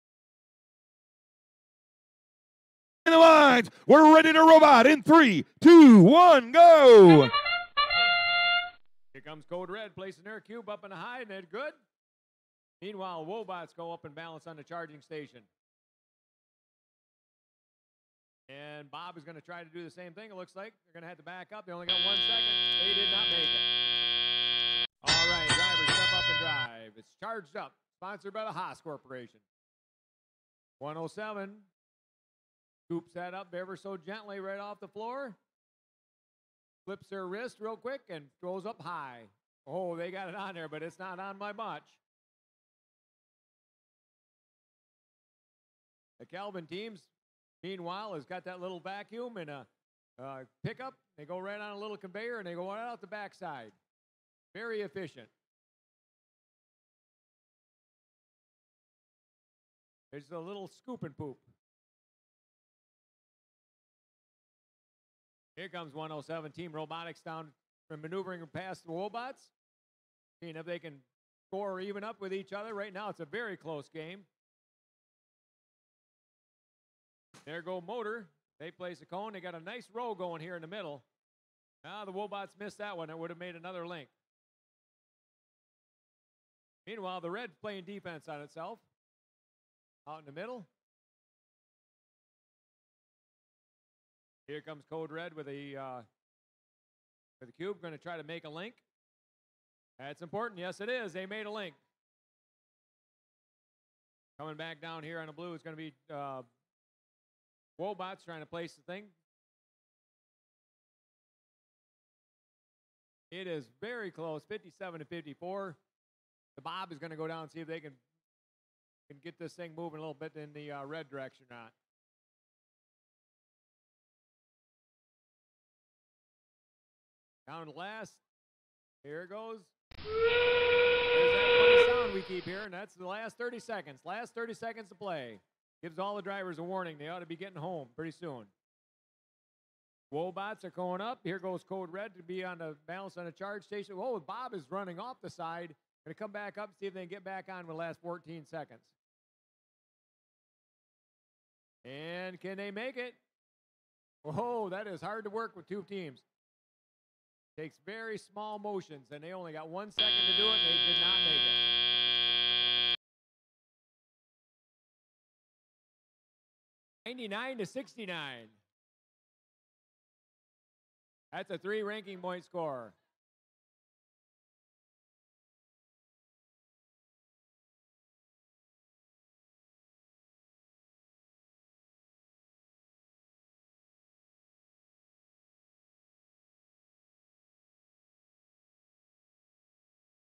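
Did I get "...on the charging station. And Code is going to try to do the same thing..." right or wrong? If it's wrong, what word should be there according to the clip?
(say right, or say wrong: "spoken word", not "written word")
wrong: "Bob", not "Code".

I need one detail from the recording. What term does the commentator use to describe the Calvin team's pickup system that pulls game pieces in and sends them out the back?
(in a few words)
scoop and poop.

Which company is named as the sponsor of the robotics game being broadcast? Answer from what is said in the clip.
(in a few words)
Haas Corporation.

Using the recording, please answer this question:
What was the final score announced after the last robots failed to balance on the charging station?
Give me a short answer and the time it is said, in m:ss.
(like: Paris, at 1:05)
99 to 69, at 2:47.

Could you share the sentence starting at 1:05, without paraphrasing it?
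Here comes 107 Team Robotics down from maneuvering past the robots.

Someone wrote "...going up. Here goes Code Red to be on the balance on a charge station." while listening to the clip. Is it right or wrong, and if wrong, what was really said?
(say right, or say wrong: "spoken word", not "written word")
right.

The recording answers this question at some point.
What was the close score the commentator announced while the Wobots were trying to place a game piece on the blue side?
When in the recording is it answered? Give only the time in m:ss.
1:54.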